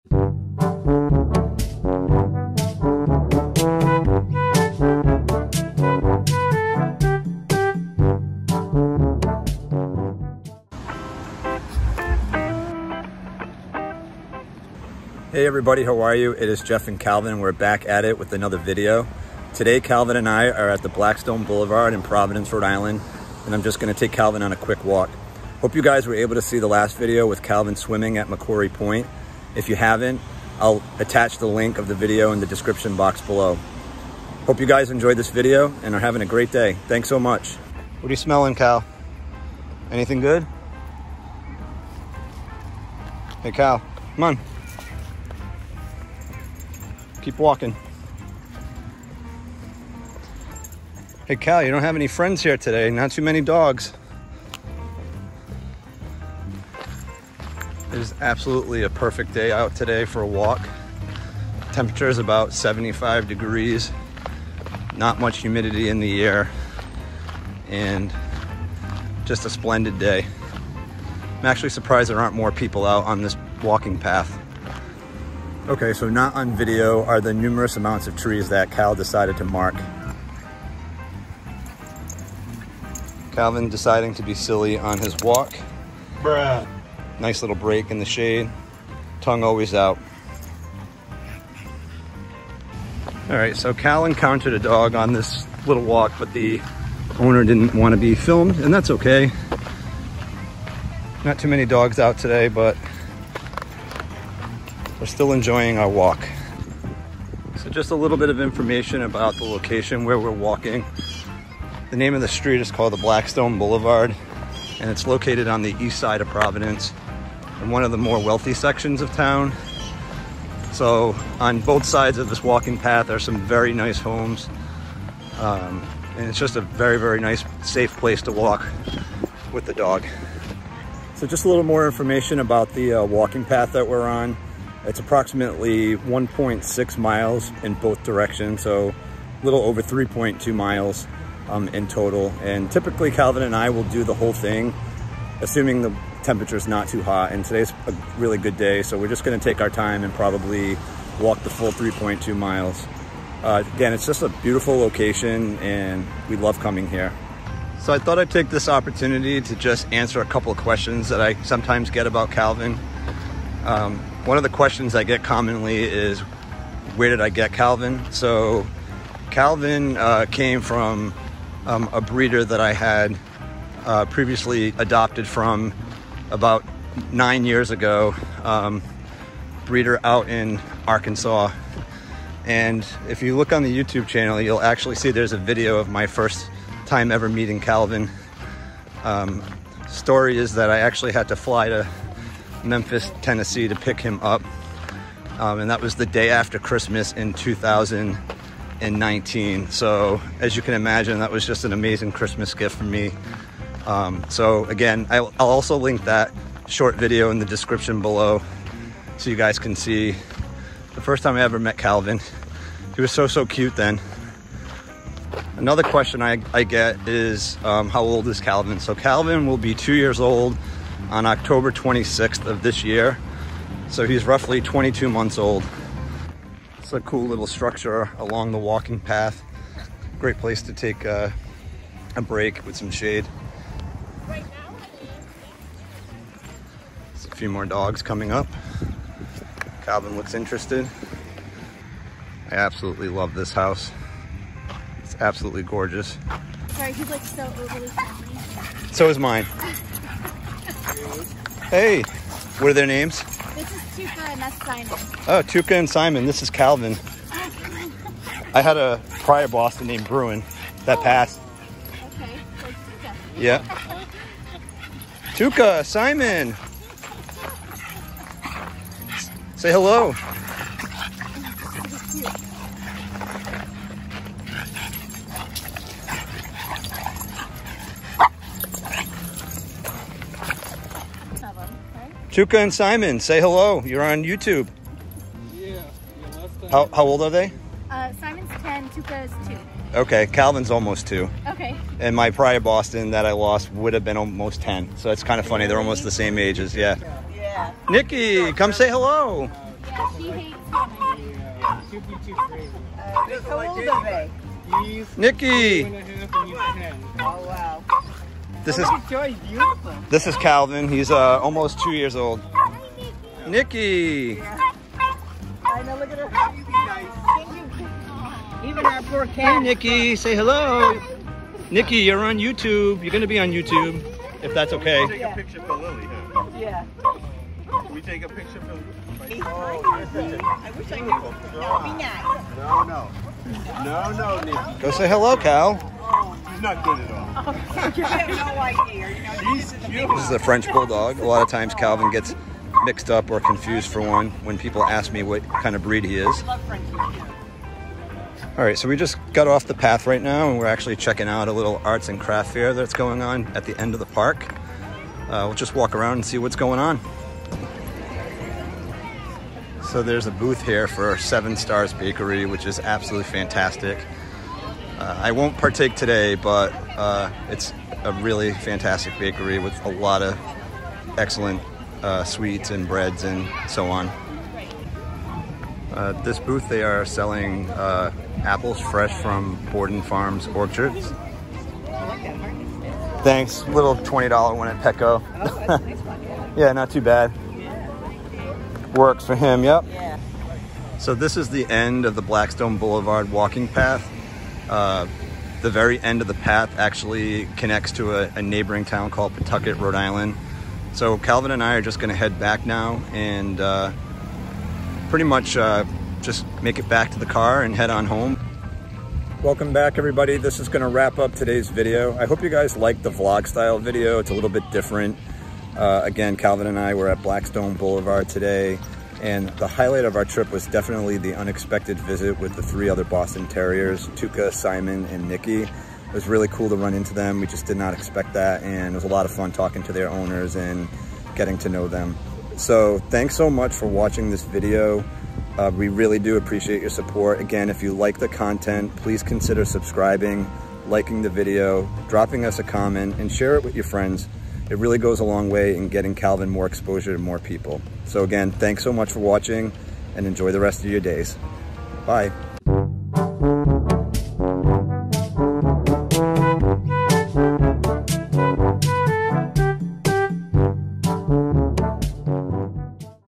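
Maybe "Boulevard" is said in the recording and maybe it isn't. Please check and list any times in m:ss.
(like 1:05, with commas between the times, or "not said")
0:21, 1:53, 6:32, 6:57.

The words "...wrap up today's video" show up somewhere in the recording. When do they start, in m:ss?
6:50.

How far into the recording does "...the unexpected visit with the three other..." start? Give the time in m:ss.
7:01.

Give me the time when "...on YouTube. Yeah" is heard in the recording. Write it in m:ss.
4:44.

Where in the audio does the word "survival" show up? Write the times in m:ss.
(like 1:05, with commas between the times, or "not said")
not said.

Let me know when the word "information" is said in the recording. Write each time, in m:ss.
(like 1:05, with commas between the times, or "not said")
1:48, 2:11.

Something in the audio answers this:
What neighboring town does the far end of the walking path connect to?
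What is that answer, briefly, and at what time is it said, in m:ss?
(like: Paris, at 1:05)
Pawtucket, at 6:39.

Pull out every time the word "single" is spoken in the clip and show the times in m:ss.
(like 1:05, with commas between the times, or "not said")
not said.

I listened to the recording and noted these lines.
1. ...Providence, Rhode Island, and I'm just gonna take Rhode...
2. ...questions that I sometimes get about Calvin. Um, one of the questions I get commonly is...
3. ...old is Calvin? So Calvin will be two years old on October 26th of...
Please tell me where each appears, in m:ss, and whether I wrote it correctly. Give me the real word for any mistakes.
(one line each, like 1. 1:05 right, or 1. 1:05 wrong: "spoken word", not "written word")
1. 0:22 wrong: "Calvin", not "Rhode"
2. 2:40 right
3. 3:38 right.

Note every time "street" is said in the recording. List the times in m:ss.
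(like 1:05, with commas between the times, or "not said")
1:52.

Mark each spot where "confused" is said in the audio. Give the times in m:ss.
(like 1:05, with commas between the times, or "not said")
5:43.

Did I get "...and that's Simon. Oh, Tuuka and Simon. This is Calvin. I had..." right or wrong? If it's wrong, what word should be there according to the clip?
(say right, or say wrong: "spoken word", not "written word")
right.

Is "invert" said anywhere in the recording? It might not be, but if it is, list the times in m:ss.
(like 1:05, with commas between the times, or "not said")
not said.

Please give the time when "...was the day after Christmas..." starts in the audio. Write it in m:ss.
3:15.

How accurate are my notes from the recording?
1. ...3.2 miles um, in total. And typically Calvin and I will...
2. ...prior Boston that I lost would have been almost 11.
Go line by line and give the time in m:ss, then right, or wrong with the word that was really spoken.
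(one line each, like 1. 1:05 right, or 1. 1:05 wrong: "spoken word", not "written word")
1. 2:19 right
2. 4:52 wrong: "10", not "11".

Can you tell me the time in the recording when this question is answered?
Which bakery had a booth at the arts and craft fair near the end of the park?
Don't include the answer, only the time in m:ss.
6:01.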